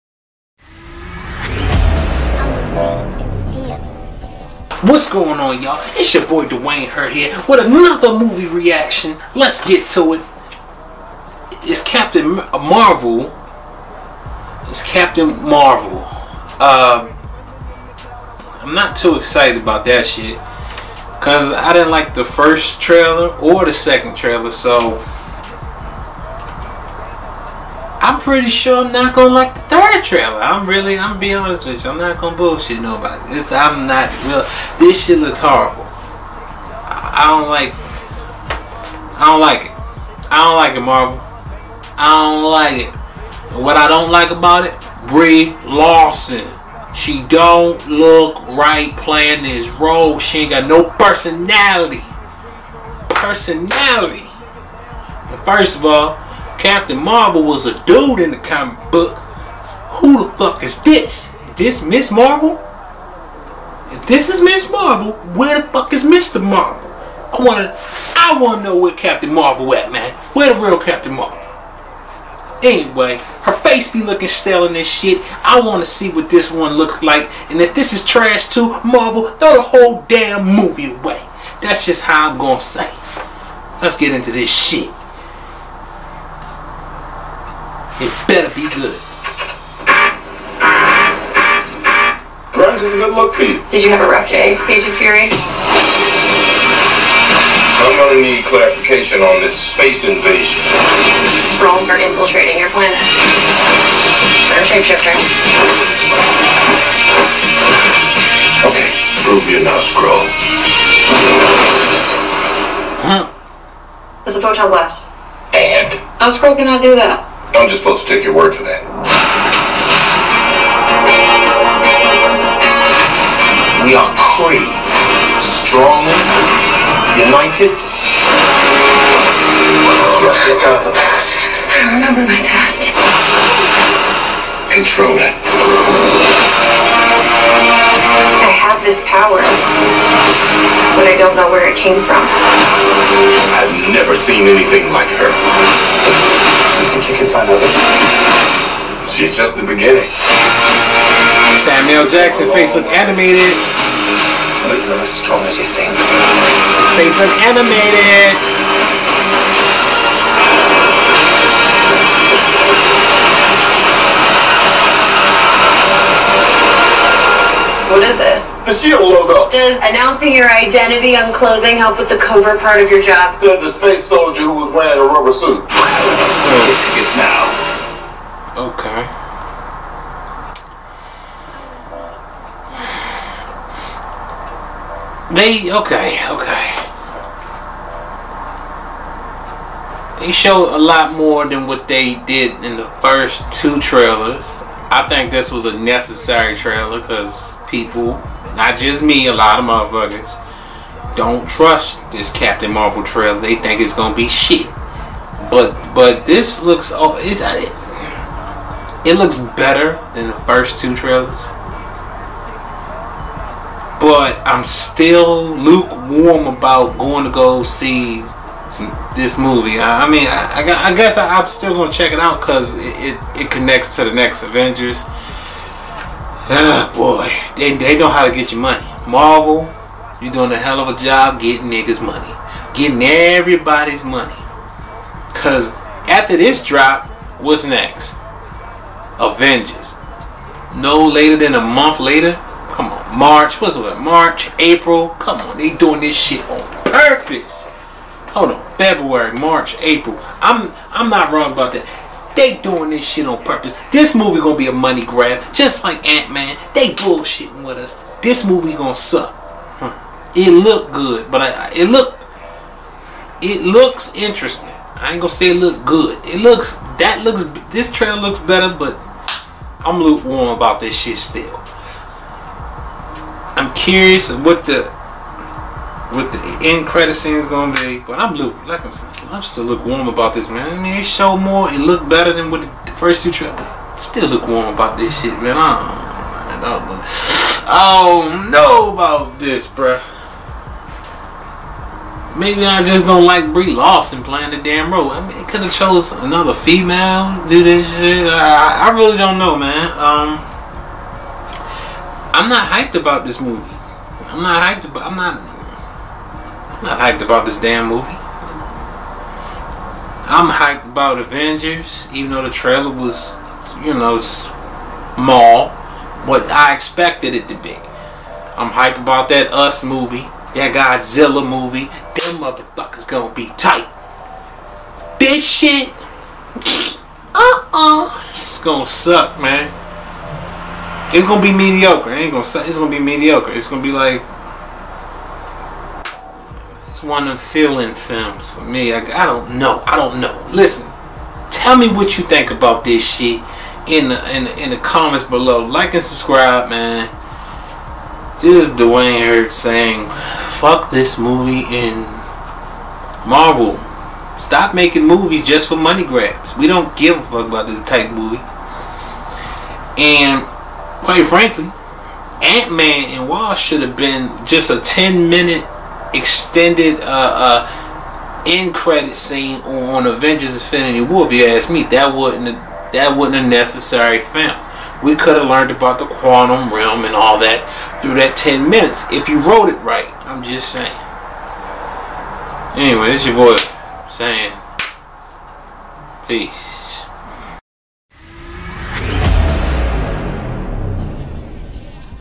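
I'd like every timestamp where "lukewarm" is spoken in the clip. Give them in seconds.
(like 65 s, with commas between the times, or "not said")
215 s, 270 s.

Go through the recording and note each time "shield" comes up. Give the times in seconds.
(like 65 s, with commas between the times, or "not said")
168 s.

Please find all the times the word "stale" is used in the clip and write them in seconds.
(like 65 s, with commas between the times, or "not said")
74 s.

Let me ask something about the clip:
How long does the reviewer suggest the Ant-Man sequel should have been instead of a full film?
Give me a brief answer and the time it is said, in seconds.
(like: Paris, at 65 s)
10 minutes, at 364 s.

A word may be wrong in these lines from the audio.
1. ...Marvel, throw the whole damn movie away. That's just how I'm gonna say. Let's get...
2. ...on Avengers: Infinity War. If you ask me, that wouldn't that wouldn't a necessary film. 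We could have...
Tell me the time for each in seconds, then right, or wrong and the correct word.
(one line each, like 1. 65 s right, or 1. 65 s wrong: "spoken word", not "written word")
1. 78 s right
2. 370 s right.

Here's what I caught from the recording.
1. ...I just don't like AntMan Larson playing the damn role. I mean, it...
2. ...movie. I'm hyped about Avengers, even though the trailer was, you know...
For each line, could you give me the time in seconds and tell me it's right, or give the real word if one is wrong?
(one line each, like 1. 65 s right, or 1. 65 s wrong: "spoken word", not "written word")
1. 292 s wrong: "Brie", not "AntMan"
2. 307 s right.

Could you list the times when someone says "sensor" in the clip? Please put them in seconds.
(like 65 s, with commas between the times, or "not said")
not said.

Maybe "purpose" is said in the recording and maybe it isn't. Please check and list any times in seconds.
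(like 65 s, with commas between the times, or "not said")
246 s, 253 s.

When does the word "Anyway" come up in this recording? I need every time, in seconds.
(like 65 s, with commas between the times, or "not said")
72 s, 382 s.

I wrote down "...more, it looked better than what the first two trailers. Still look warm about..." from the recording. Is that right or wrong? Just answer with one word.
right.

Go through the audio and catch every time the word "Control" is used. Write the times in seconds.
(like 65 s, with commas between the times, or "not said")
134 s.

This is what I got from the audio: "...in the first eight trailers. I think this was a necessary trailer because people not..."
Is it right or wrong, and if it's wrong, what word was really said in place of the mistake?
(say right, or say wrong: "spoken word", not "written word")
wrong: "two", not "eight".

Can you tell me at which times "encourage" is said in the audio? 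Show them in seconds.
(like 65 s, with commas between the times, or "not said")
not said.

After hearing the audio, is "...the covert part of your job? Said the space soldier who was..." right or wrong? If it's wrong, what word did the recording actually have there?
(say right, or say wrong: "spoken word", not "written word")
right.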